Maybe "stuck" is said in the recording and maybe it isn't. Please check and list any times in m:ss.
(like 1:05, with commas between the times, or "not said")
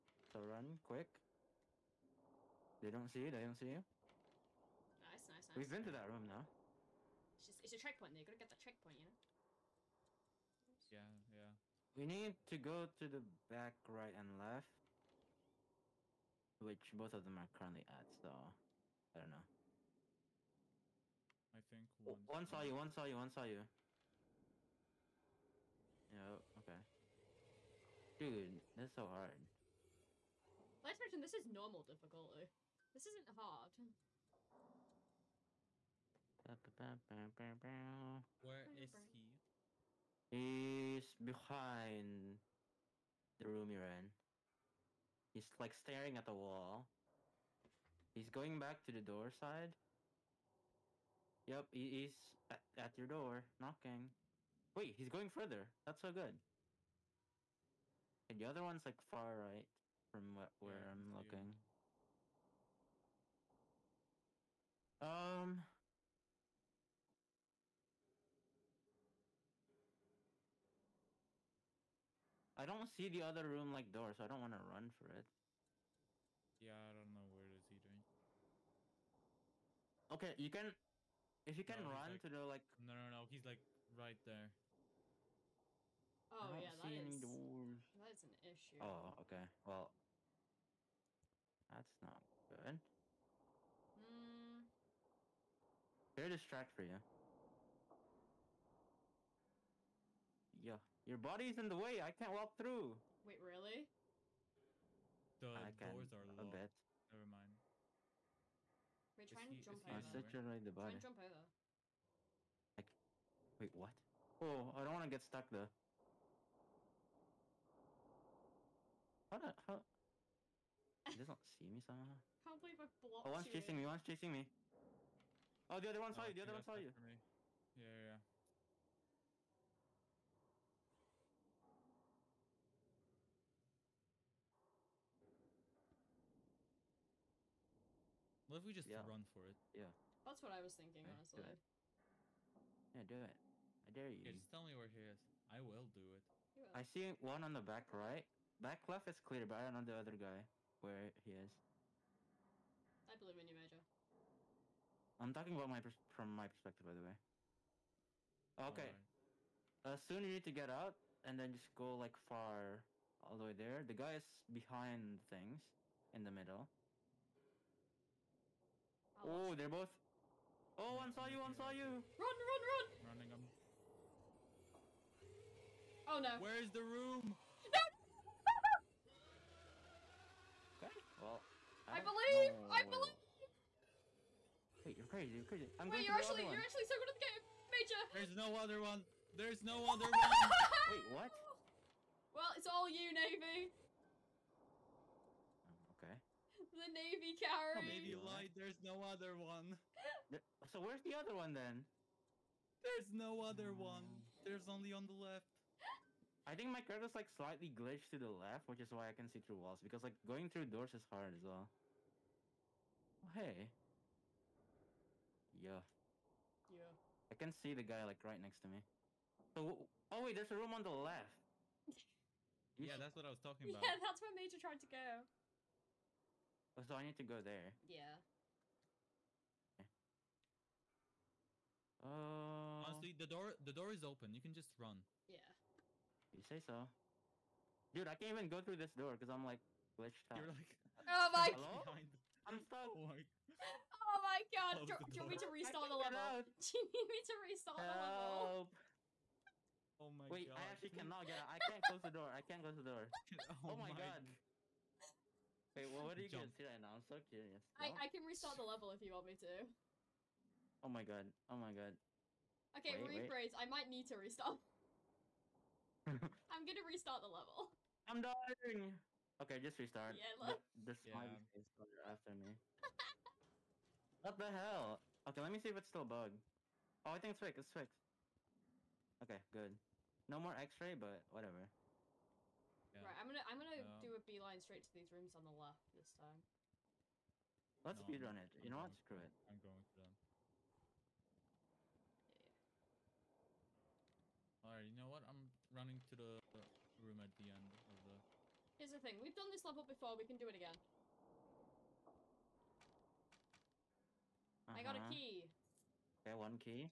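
1:55, 4:02.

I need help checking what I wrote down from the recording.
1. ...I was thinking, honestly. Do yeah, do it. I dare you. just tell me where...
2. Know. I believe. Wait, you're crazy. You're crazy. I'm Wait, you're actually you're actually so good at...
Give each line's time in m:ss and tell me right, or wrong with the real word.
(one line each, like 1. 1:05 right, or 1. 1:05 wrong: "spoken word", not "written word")
1. 2:20 right
2. 3:02 right.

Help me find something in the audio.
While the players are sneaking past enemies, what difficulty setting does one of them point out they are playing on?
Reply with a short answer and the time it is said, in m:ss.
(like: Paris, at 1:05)
Normal, at 0:31.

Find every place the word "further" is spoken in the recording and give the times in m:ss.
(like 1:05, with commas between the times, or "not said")
0:55.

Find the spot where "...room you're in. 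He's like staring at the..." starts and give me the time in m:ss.
0:43.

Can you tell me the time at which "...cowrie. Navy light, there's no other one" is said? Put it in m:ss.
3:17.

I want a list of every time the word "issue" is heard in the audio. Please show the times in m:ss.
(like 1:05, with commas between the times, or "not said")
1:28.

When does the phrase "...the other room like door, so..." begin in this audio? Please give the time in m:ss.
1:13.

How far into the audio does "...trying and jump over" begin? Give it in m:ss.
1:49.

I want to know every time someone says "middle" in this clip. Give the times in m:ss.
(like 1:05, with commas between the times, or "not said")
2:46.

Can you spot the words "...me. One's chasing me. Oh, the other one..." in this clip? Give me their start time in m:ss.
2:03.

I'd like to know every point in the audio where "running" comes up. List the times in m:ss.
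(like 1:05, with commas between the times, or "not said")
2:53, 4:55.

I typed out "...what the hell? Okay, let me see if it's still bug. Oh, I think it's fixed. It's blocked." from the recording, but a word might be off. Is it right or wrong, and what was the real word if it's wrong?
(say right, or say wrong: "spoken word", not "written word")
wrong: "fixed", not "blocked".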